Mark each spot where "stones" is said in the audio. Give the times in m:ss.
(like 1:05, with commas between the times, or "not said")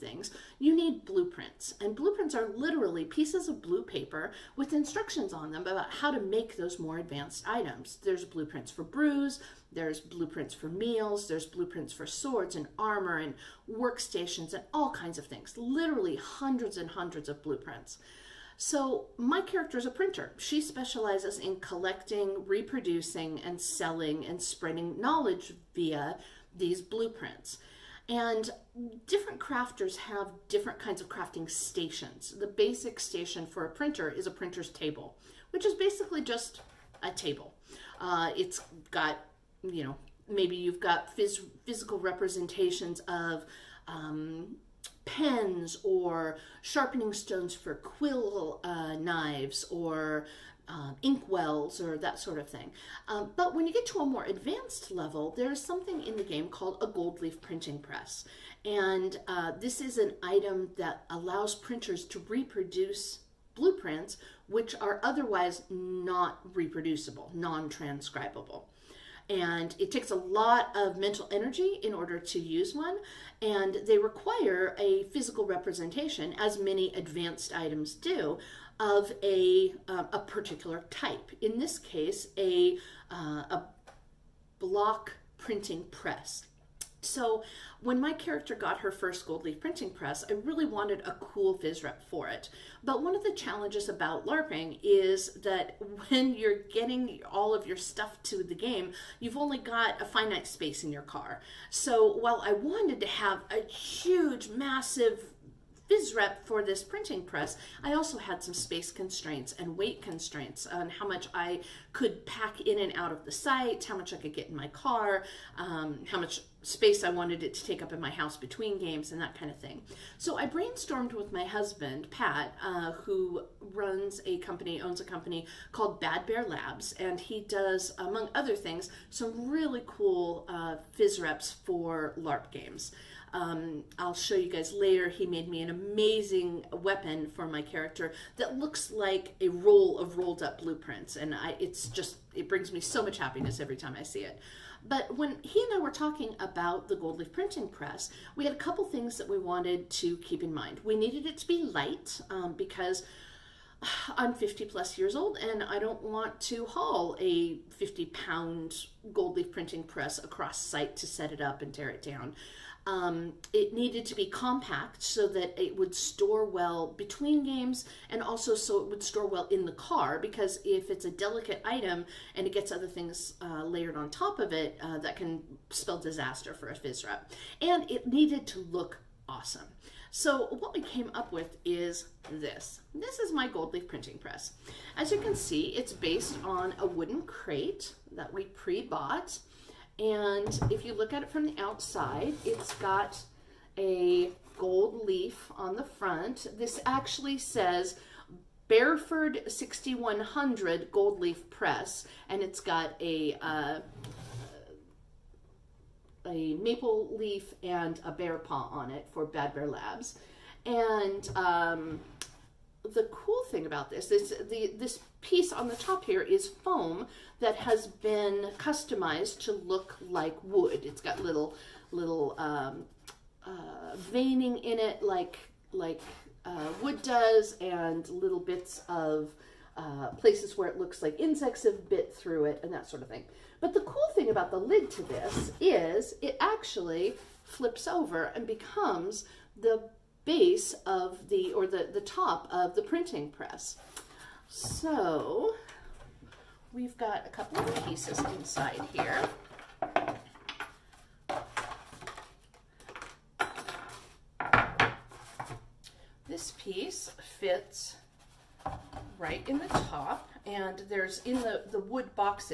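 0:47.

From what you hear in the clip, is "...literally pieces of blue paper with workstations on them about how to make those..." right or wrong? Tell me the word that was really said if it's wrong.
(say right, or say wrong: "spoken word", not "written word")
wrong: "instructions", not "workstations".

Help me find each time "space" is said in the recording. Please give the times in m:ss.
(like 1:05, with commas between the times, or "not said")
1:40, 1:48, 1:56.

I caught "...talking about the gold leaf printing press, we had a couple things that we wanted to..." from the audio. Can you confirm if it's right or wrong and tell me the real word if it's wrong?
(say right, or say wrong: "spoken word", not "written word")
right.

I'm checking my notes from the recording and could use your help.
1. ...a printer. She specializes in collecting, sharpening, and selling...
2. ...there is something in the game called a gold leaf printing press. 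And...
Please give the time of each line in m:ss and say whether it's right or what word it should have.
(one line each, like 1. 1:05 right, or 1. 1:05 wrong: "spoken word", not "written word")
1. 0:19 wrong: "reproducing", not "sharpening"
2. 0:55 right.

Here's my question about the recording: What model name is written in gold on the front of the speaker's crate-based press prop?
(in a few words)
Bearford 6100.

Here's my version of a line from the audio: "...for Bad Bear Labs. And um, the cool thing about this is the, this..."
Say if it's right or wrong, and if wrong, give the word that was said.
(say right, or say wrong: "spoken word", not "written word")
right.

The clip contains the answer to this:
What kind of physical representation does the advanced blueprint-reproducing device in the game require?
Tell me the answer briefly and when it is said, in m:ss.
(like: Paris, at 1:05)
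block printing press, at 1:24.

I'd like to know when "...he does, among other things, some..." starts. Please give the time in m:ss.
2:07.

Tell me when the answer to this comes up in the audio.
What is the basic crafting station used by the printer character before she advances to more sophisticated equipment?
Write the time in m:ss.
0:34.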